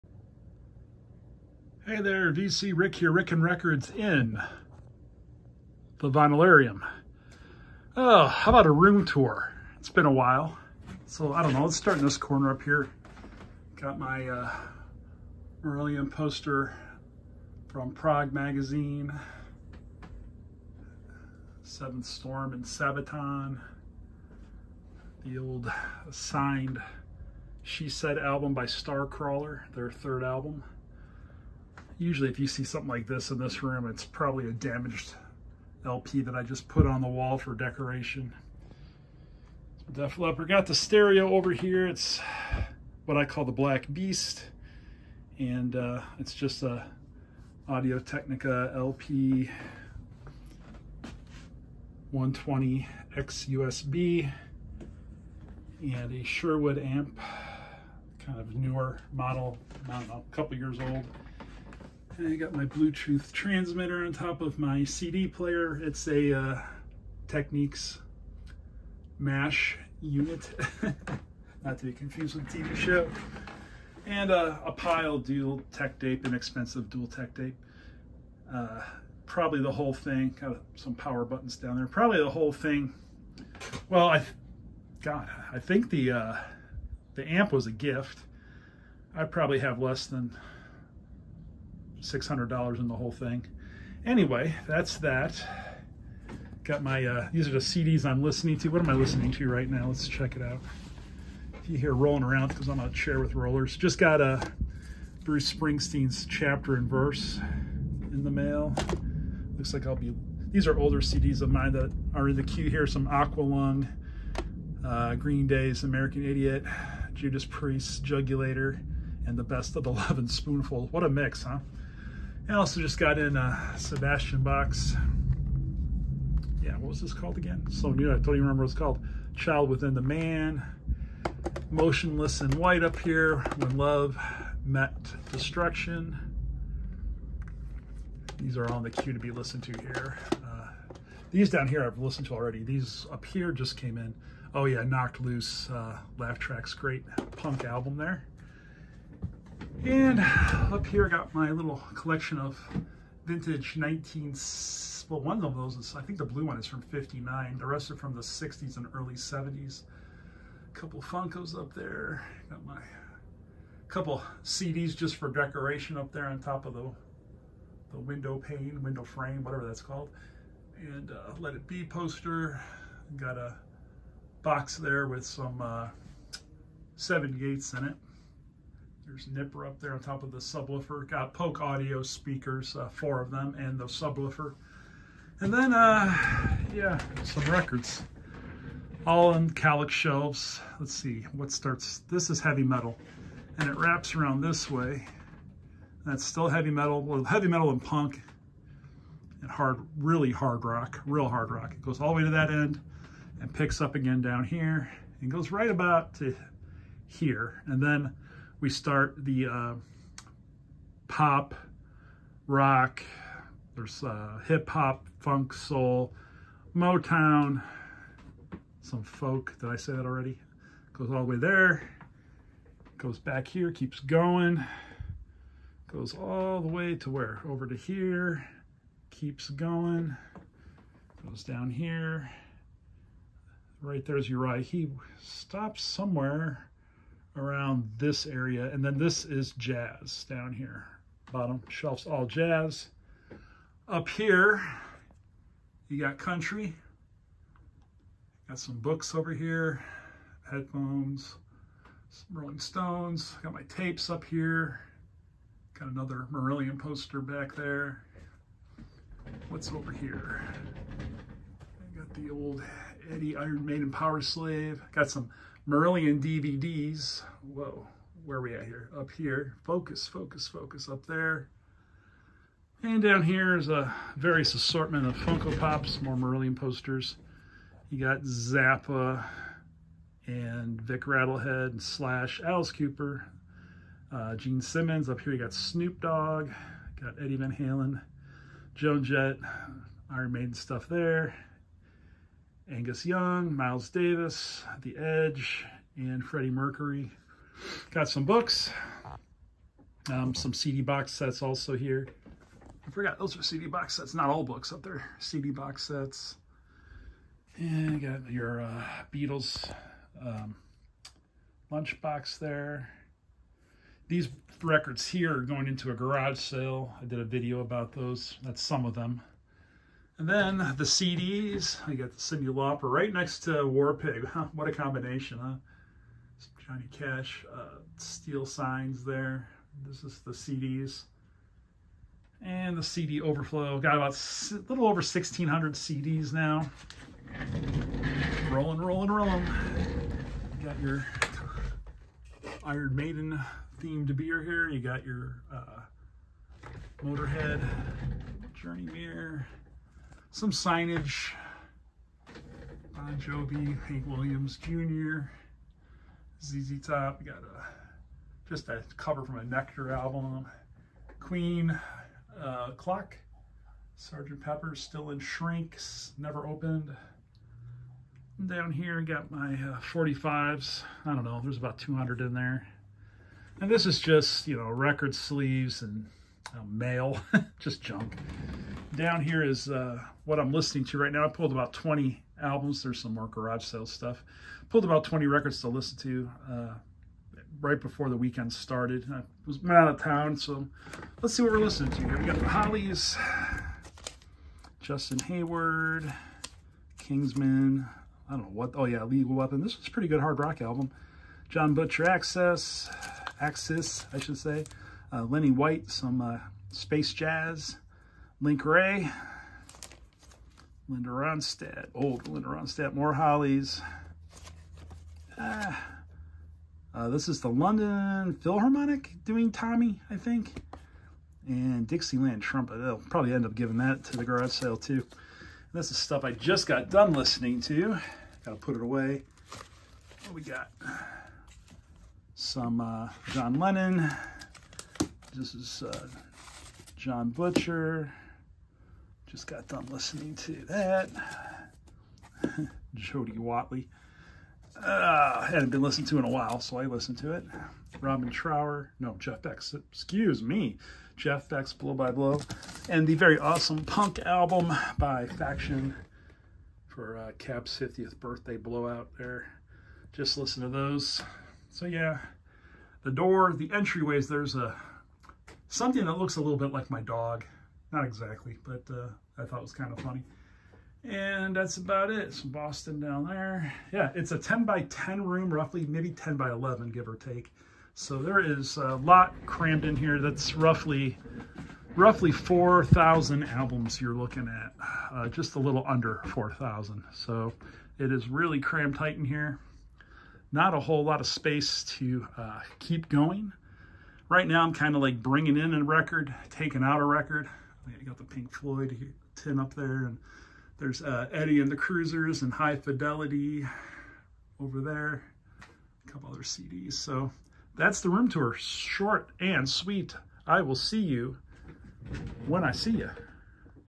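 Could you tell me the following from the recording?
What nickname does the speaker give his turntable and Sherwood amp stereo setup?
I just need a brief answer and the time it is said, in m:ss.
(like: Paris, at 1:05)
Black Beast, at 0:43.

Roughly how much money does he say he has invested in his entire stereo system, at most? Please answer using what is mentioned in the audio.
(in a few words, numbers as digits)
$600.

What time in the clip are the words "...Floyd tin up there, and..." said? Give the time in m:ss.
8:18.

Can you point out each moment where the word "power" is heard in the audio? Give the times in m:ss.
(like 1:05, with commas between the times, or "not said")
1:20, 4:23.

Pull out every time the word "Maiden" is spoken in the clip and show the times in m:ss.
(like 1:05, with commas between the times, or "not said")
4:23, 4:50, 5:42.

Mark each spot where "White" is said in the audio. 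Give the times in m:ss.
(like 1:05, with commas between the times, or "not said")
2:12, 6:45.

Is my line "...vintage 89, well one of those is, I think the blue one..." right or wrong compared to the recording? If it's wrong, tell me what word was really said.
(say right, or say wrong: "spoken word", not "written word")
wrong: "19", not "89".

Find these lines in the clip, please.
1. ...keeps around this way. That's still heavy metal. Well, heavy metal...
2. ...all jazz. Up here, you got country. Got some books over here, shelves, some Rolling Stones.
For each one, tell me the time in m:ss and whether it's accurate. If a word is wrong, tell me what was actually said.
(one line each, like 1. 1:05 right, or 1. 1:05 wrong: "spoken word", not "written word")
1. 3:13 wrong: "wraps", not "keeps"
2. 4:02 wrong: "headphones", not "shelves".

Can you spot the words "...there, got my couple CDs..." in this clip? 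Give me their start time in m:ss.
2:41.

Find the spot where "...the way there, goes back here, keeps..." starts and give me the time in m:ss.
3:41.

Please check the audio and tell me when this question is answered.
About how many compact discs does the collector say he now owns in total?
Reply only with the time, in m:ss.
5:35.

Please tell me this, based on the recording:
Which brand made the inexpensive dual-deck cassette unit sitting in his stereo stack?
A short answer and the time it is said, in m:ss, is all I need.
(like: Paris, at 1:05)
Pyle, at 1:14.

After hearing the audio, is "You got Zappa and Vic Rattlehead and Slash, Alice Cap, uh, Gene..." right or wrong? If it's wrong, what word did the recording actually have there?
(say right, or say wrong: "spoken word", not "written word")
wrong: "Cooper", not "Cap".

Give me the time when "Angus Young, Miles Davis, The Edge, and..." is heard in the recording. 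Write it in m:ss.
4:52.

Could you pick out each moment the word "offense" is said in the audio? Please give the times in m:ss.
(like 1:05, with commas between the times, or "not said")
not said.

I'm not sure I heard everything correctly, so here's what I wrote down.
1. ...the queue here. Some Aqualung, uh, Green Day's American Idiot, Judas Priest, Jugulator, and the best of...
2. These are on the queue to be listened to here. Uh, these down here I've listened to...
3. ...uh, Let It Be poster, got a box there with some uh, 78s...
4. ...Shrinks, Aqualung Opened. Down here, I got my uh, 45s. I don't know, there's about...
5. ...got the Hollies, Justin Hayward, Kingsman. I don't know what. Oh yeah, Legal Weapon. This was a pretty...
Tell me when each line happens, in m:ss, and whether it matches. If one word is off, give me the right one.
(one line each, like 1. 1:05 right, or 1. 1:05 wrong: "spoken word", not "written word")
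1. 1:52 right
2. 2:18 right
3. 2:51 right
4. 6:05 wrong: "Never", not "Aqualung"
5. 6:32 right.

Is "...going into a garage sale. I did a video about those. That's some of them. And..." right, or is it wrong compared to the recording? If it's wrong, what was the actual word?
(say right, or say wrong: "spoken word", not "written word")
right.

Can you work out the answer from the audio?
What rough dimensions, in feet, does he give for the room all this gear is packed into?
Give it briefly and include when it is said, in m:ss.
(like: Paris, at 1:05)
10 by 10, at 7:54.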